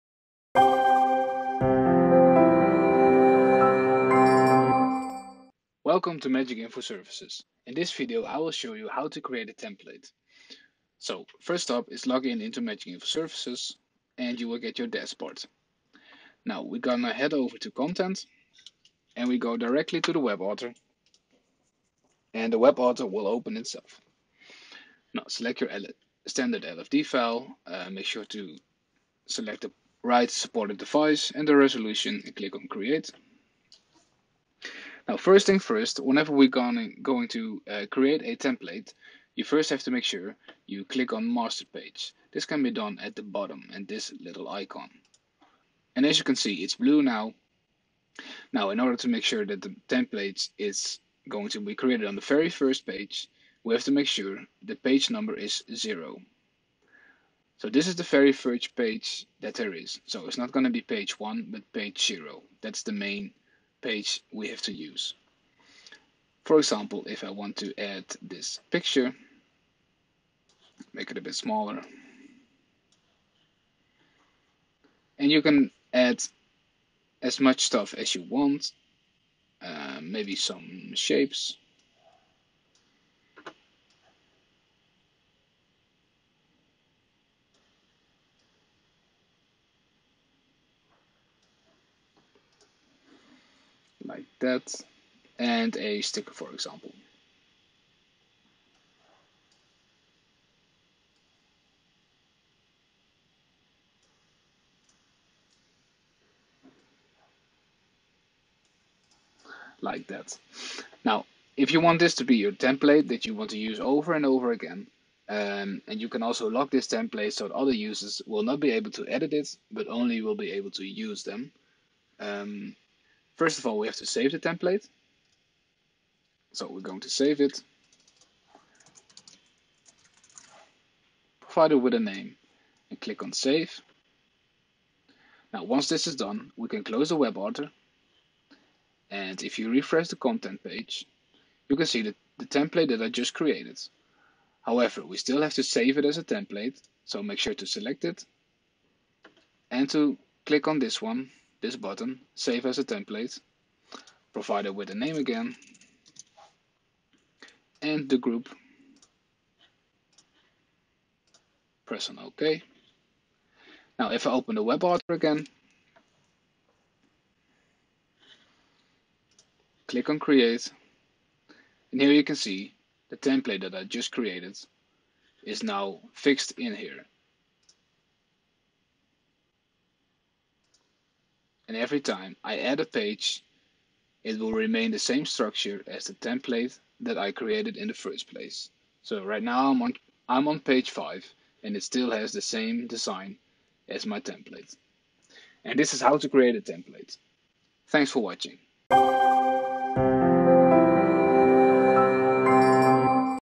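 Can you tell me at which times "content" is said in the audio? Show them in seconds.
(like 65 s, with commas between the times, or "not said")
17 s, 140 s.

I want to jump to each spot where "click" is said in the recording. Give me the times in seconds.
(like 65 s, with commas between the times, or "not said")
32 s, 40 s, 133 s, 150 s, 169 s.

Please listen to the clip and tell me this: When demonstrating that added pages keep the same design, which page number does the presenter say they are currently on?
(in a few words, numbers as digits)
5.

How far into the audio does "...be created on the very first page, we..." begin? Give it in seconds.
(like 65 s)
51 s.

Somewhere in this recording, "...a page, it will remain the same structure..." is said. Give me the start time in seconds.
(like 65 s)
182 s.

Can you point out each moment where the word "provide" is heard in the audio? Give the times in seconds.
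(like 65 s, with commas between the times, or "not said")
131 s, 154 s.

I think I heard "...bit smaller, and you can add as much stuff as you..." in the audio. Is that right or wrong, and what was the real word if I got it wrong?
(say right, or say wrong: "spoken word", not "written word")
right.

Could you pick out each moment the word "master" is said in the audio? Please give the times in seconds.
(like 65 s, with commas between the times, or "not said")
41 s.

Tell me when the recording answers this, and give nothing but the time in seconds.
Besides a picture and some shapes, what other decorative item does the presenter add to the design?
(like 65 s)
96 s.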